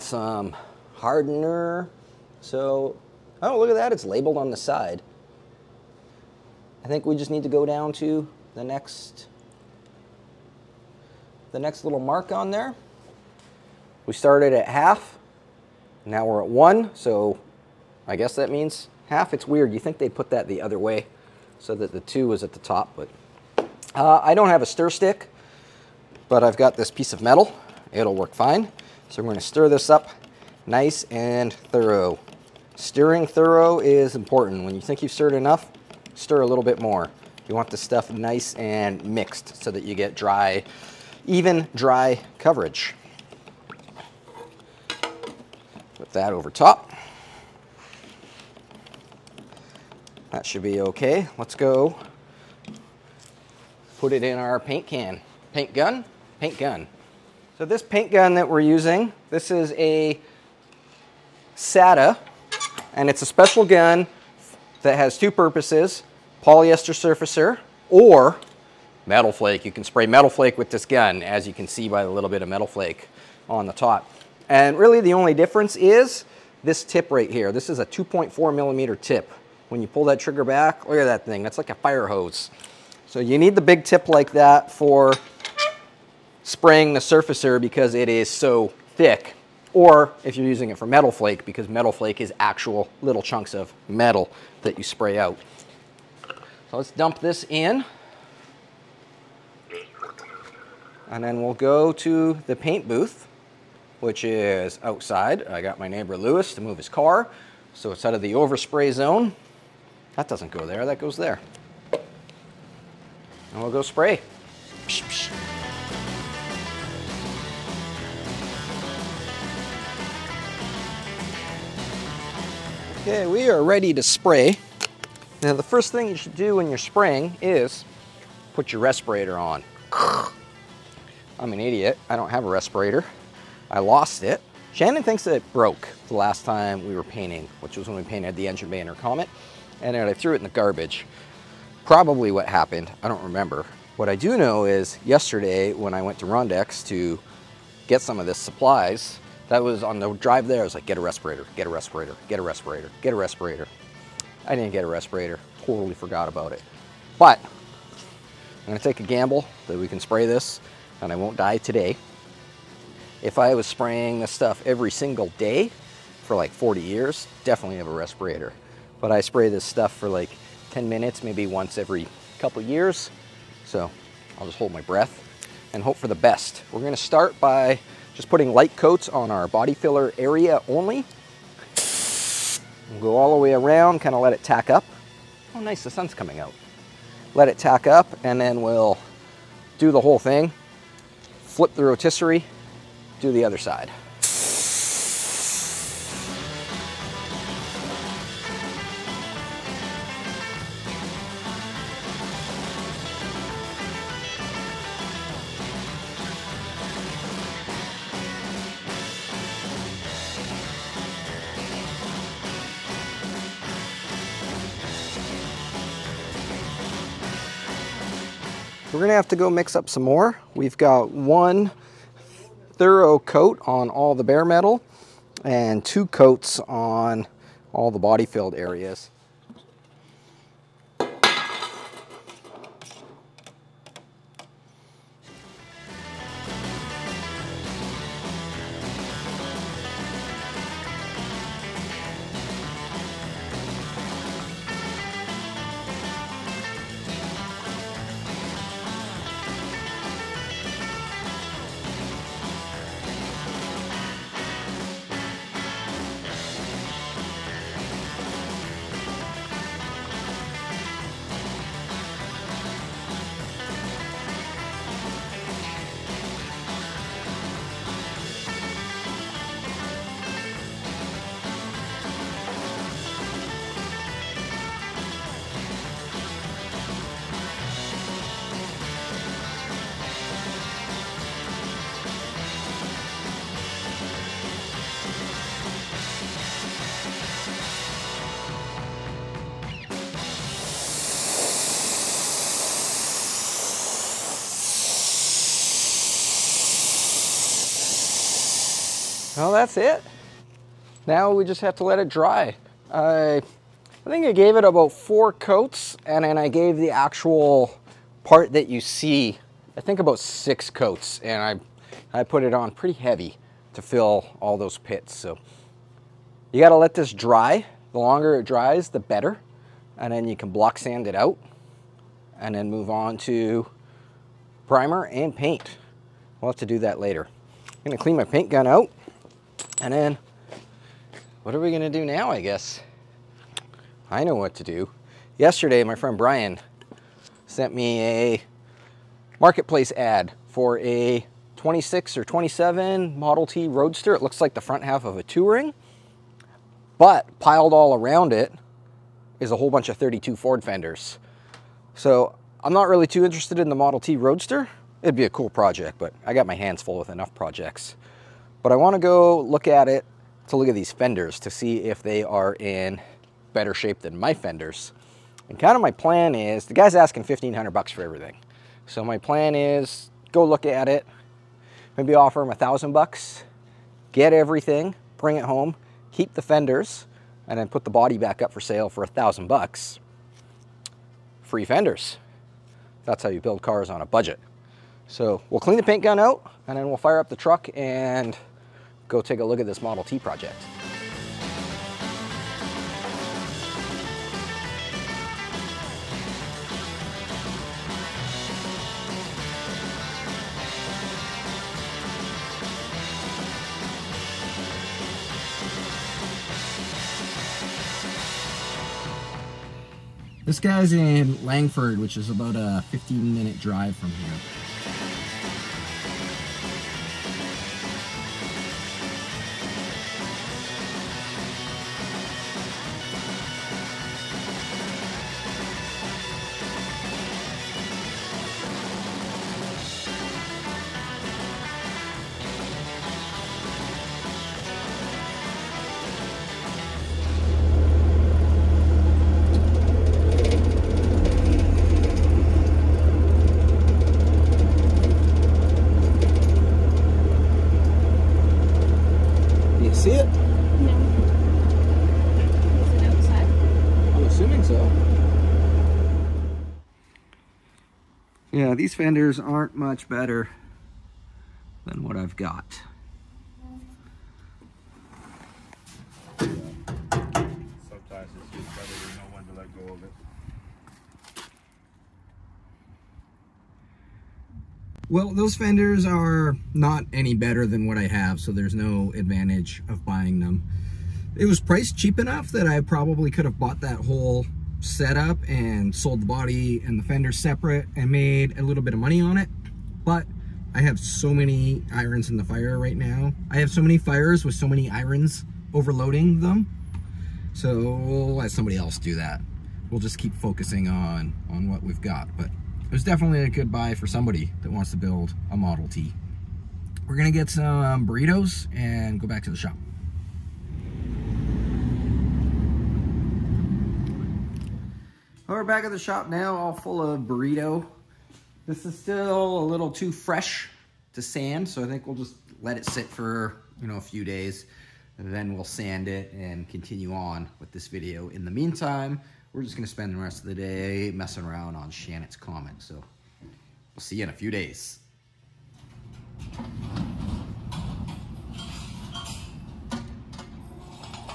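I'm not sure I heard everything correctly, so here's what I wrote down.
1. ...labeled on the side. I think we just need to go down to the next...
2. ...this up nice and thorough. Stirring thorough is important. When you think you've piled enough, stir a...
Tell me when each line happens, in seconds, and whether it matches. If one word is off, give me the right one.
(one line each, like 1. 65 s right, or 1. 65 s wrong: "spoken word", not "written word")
1. 4 s right
2. 29 s wrong: "stirred", not "piled".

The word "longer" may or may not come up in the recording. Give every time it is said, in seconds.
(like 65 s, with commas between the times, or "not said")
317 s.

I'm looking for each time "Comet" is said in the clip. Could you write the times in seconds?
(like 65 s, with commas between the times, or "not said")
138 s, 532 s.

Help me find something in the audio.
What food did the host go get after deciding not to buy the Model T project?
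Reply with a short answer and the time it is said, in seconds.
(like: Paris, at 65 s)
Burritos, at 508 s.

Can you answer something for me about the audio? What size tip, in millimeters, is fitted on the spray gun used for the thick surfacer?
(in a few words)
2.4 millimeter.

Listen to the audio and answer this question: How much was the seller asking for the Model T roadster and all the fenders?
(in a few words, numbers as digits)
$1500.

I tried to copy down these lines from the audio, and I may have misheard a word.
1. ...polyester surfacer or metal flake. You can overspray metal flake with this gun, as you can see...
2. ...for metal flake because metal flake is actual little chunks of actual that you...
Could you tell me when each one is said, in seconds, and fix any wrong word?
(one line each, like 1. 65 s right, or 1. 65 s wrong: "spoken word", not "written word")
1. 66 s wrong: "spray", not "overspray"
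2. 90 s wrong: "metal", not "actual".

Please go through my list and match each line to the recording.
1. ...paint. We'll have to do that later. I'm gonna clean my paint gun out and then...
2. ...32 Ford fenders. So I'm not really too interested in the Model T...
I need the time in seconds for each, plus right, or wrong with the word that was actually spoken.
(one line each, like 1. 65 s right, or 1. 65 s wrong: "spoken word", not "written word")
1. 325 s right
2. 349 s right.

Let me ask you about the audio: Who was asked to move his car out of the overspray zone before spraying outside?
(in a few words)
Lewis.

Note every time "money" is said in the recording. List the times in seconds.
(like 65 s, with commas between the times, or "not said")
488 s.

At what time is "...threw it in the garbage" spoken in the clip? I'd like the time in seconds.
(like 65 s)
140 s.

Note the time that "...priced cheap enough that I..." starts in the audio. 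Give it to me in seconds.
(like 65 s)
481 s.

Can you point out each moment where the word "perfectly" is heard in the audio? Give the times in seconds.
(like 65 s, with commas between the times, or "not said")
not said.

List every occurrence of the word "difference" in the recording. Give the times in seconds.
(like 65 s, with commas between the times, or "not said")
75 s.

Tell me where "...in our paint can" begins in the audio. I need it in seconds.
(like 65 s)
54 s.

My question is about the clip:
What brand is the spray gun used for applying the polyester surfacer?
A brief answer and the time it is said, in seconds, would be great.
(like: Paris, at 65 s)
SATA, at 61 s.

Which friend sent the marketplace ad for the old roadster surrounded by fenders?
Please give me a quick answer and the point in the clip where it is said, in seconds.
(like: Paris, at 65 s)
Brian, at 336 s.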